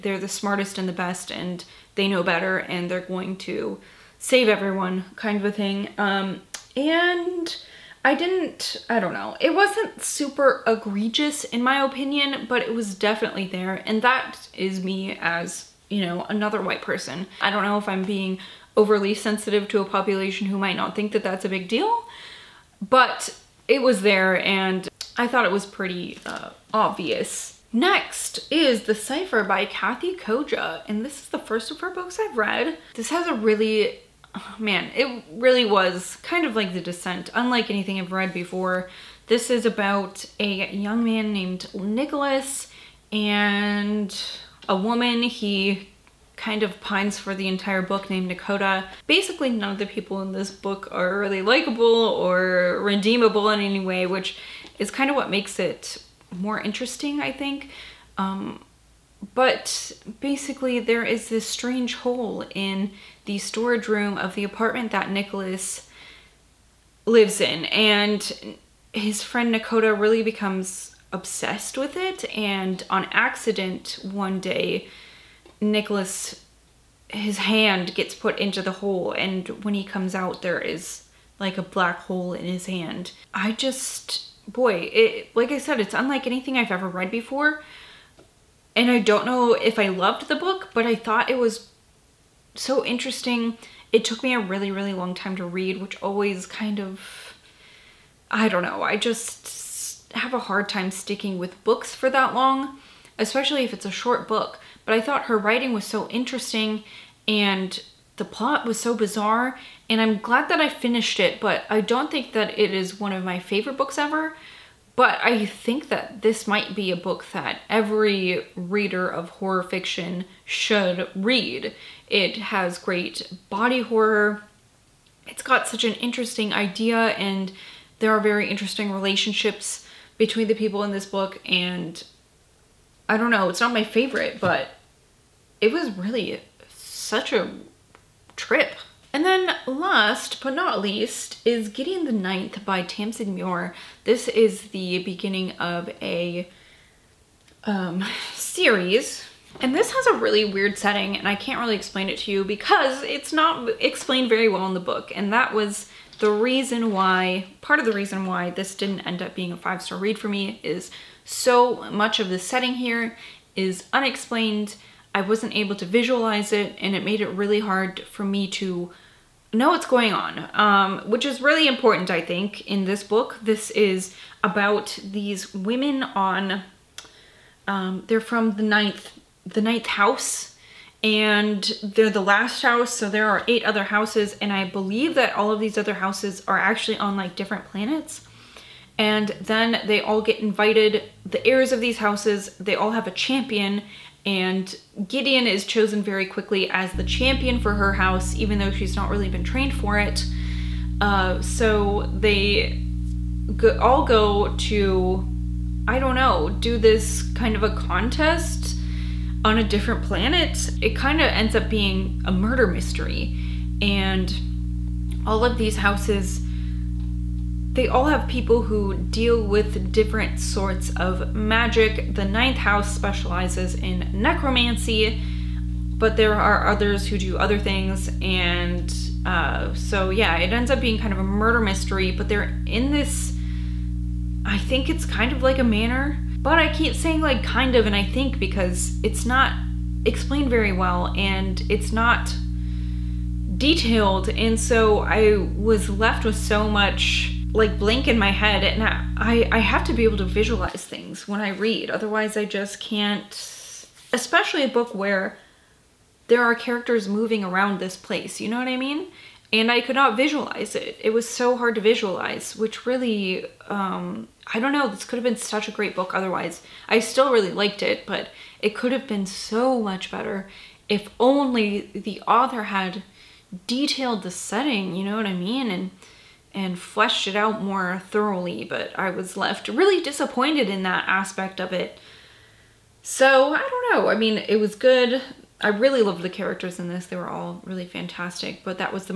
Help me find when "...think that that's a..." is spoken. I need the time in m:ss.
0:20.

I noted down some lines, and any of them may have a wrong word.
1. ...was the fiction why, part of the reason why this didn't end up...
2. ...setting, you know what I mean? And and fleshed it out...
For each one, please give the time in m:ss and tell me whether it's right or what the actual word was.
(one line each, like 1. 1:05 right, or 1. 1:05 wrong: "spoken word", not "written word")
1. 2:35 wrong: "reason", not "fiction"
2. 4:34 right.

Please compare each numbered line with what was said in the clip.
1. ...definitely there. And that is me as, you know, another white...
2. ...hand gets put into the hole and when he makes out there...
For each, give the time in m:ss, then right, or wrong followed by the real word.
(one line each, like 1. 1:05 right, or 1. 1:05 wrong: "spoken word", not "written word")
1. 0:12 right
2. 1:17 wrong: "comes", not "makes".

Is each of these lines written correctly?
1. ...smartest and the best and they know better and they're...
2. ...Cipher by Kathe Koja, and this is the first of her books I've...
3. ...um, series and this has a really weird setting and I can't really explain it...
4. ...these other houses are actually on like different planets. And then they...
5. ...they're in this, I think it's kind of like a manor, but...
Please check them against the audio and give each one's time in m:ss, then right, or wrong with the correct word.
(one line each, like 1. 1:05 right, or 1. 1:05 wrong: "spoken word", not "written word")
1. 0:00 right
2. 0:28 right
3. 2:27 right
4. 3:05 right
5. 3:52 right.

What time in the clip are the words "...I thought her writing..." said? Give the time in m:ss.
1:44.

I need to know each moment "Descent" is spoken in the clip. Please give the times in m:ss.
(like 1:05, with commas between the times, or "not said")
0:36.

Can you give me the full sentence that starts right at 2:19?
And then last but not least is Gideon the Ninth by Tamsyn Muir.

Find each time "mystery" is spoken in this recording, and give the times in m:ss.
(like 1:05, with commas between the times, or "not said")
3:32, 3:51.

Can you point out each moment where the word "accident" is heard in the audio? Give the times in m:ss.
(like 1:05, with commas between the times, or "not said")
1:13.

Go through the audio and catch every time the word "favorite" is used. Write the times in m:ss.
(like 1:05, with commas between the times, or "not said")
1:53, 2:13.